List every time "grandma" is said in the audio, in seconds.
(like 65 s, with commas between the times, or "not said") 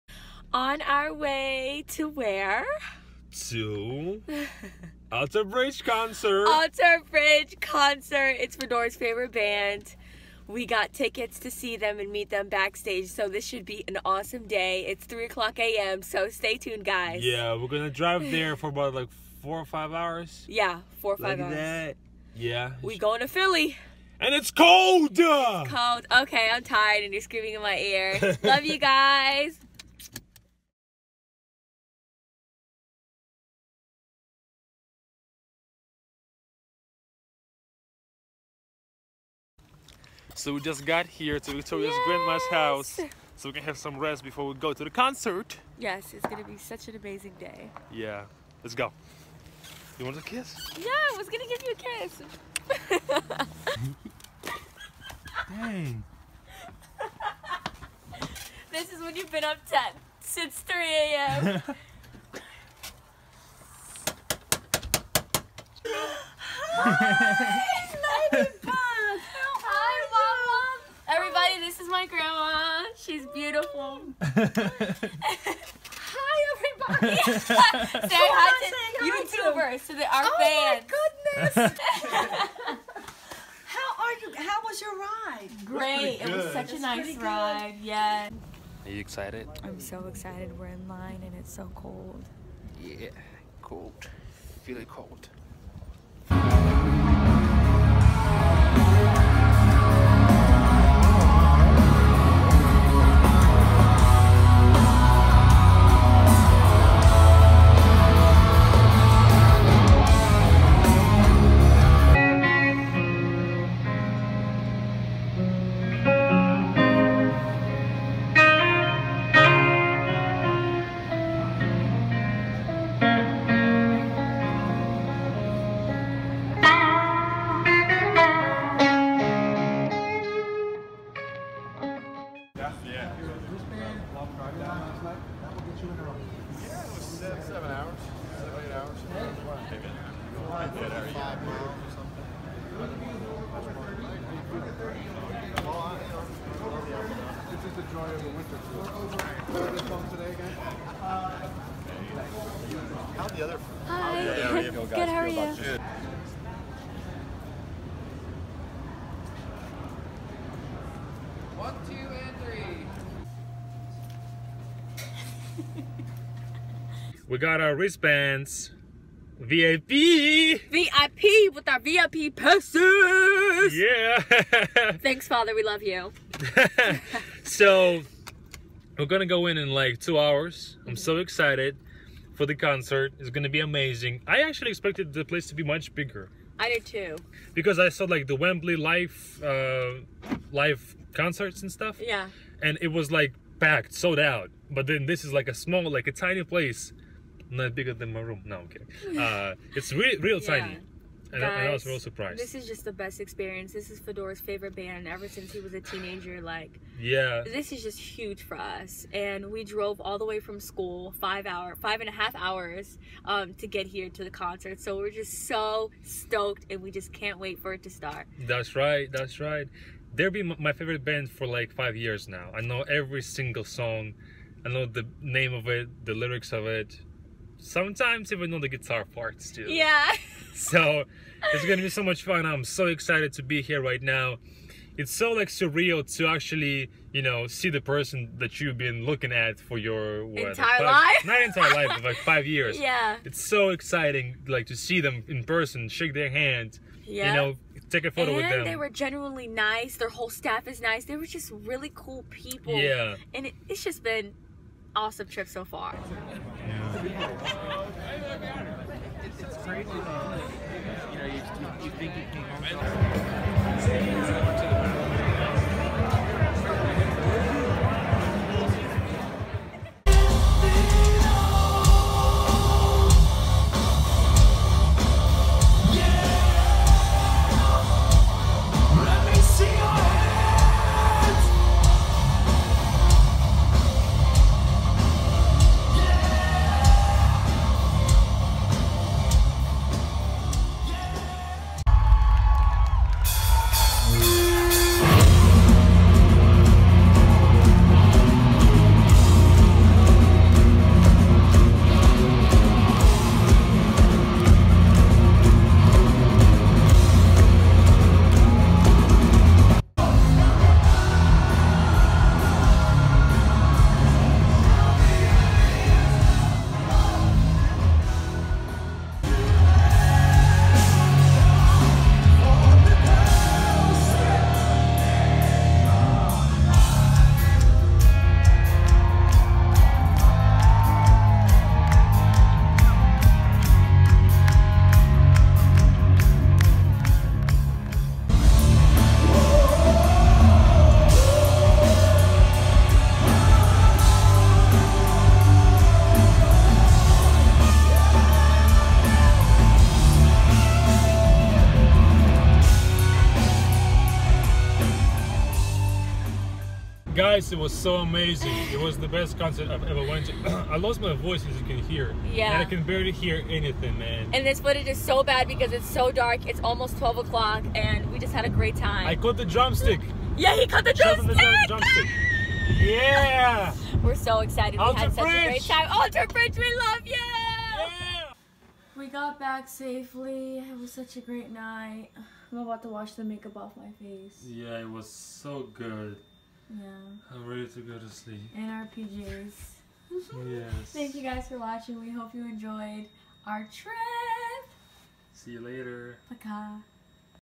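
42 s, 72 s.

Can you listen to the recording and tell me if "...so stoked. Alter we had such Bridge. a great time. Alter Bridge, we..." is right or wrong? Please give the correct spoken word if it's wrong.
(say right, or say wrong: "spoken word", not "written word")
wrong: "excited", not "stoked".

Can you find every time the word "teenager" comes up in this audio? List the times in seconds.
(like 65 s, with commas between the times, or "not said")
205 s.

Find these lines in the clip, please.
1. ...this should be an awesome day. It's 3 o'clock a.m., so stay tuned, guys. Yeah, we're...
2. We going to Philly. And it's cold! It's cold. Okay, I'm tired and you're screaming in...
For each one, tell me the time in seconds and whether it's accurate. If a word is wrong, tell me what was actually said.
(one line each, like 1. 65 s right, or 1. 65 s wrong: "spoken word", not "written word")
1. 13 s right
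2. 22 s right.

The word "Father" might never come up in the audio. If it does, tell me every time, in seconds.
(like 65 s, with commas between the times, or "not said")
175 s.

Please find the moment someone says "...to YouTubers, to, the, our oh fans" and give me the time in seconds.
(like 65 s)
78 s.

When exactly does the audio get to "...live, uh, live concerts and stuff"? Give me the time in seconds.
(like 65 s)
188 s.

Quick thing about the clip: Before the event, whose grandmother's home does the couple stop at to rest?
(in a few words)
Victoria's.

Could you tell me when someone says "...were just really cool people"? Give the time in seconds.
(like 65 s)
251 s.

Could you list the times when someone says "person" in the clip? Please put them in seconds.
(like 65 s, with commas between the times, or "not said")
237 s, 245 s.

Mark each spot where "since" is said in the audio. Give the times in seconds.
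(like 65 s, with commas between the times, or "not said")
60 s, 205 s.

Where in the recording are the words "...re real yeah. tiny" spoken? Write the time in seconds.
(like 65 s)
199 s.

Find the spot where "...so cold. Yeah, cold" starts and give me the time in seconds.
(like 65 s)
91 s.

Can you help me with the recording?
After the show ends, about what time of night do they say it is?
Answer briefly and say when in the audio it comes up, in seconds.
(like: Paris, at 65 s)
Almost 12 o'clock, at 366 s.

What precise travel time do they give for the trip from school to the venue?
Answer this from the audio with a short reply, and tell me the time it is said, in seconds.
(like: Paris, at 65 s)
5 and a half hours, at 211 s.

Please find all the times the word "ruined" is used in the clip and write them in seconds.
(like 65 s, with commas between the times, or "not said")
not said.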